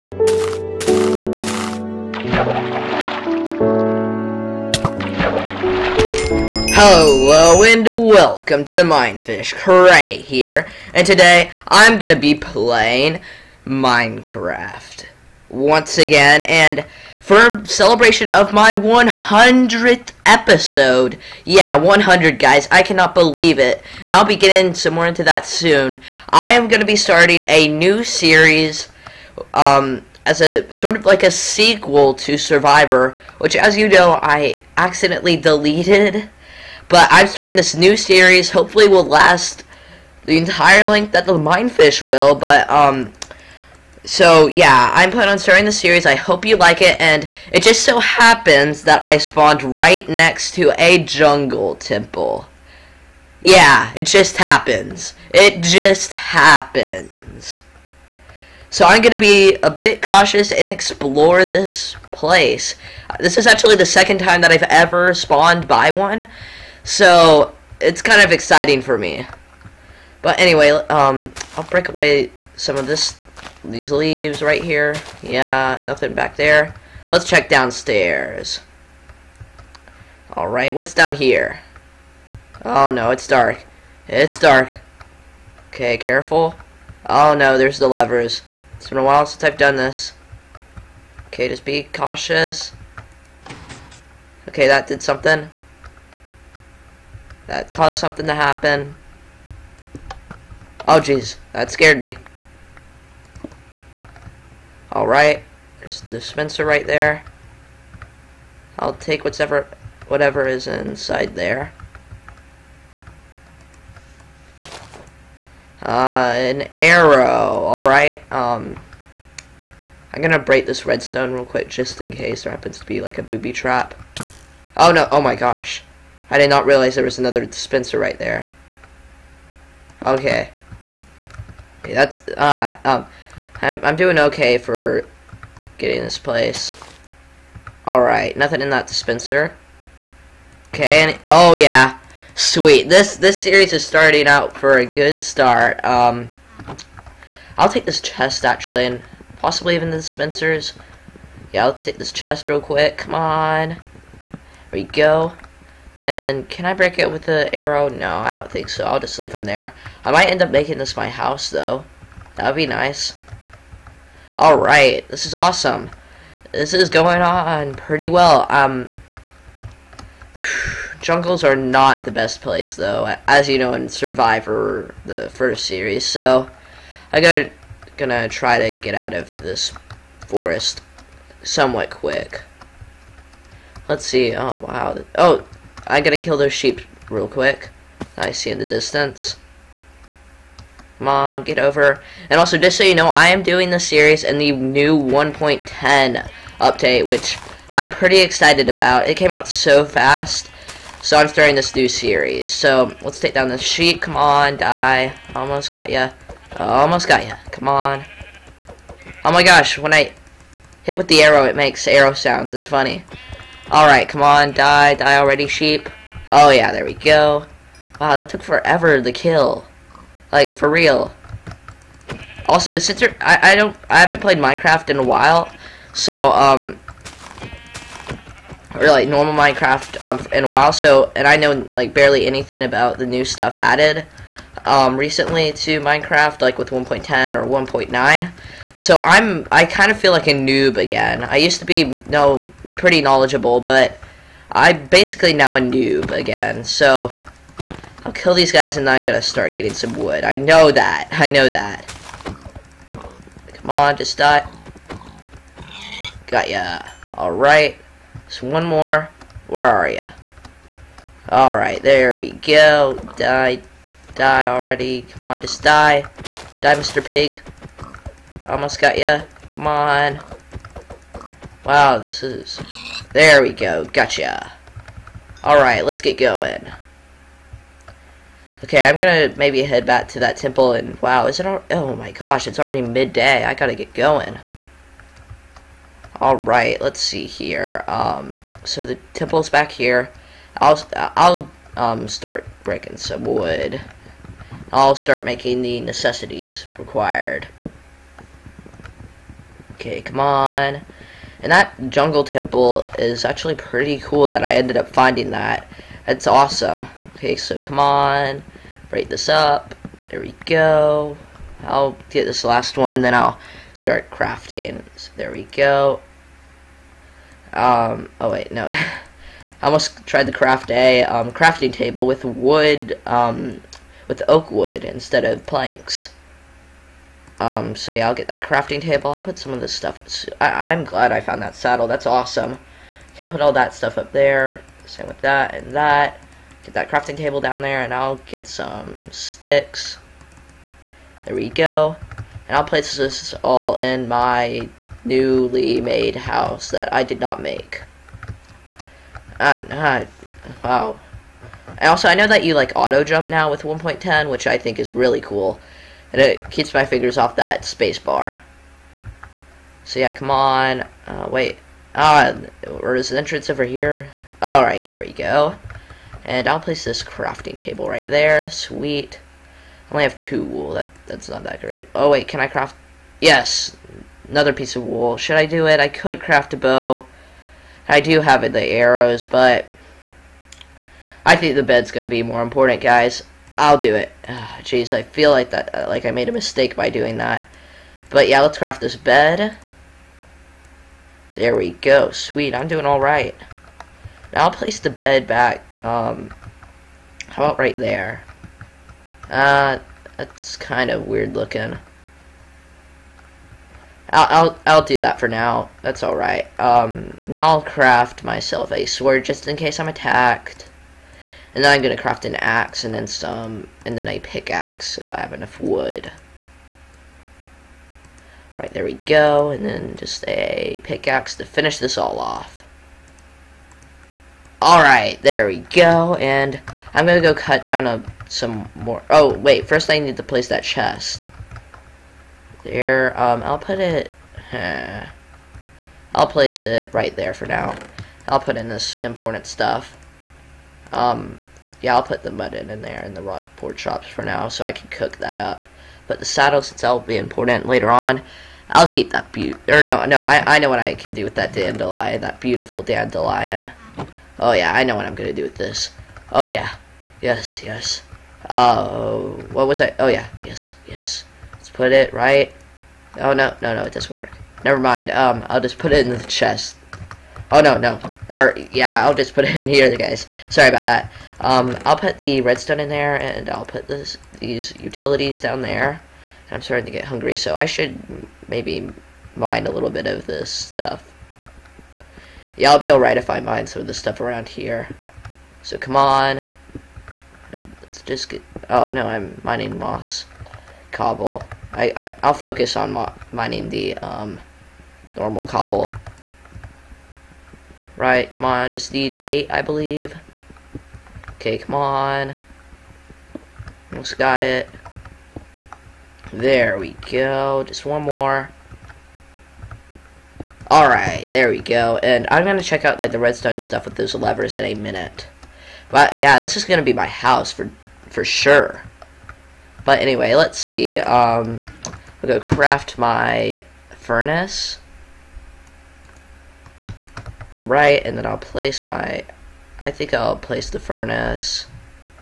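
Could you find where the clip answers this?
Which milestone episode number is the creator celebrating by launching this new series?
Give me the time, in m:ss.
0:18.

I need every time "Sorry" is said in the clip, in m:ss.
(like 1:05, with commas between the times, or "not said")
7:50.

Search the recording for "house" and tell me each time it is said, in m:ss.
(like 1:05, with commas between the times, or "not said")
2:41, 5:46, 8:37.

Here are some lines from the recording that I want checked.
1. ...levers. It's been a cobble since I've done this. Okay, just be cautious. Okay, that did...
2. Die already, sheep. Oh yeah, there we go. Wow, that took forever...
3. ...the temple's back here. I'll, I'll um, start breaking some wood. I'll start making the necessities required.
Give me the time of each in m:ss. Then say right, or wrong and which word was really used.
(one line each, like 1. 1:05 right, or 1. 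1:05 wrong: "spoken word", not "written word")
1. 1:27 wrong: "while", not "cobble"
2. 3:34 right
3. 4:48 right.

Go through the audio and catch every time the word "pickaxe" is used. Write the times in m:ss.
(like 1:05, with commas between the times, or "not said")
6:54, 7:00.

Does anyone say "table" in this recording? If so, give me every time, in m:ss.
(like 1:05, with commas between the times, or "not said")
5:21, 5:28, 5:37, 6:07.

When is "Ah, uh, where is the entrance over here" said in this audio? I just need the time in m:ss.
6:01.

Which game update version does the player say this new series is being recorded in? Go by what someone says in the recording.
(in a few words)
1.10.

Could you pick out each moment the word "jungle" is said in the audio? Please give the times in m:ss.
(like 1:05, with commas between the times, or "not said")
0:51, 2:50, 5:01.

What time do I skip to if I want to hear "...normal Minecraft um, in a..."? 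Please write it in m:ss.
3:49.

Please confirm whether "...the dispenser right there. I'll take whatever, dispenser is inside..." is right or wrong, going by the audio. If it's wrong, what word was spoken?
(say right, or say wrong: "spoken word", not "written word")
wrong: "whatever", not "dispenser".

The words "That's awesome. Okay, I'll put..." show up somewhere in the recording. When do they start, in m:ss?
5:31.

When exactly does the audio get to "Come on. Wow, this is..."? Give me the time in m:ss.
4:29.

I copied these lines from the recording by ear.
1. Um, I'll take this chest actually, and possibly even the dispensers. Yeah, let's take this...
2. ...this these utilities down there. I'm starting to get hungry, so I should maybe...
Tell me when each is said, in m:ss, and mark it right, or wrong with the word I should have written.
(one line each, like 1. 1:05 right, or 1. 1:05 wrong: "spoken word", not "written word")
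1. 2:25 right
2. 7:53 right.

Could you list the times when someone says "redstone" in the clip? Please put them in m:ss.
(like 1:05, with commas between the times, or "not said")
2:00, 7:52, 8:33.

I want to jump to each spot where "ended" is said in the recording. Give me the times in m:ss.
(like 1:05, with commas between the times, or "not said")
5:04.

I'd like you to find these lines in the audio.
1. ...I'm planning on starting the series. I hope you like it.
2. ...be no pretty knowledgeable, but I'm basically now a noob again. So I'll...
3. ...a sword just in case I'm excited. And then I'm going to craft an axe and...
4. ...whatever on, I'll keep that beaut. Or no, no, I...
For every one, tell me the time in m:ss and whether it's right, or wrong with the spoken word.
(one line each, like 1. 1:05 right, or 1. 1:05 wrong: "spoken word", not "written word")
1. 0:44 right
2. 4:01 right
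3. 6:48 wrong: "attacked", not "excited"
4. 7:27 wrong: "later", not "whatever".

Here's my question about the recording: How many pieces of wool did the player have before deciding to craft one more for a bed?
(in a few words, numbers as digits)
2.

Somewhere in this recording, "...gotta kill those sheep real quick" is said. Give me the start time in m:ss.
3:05.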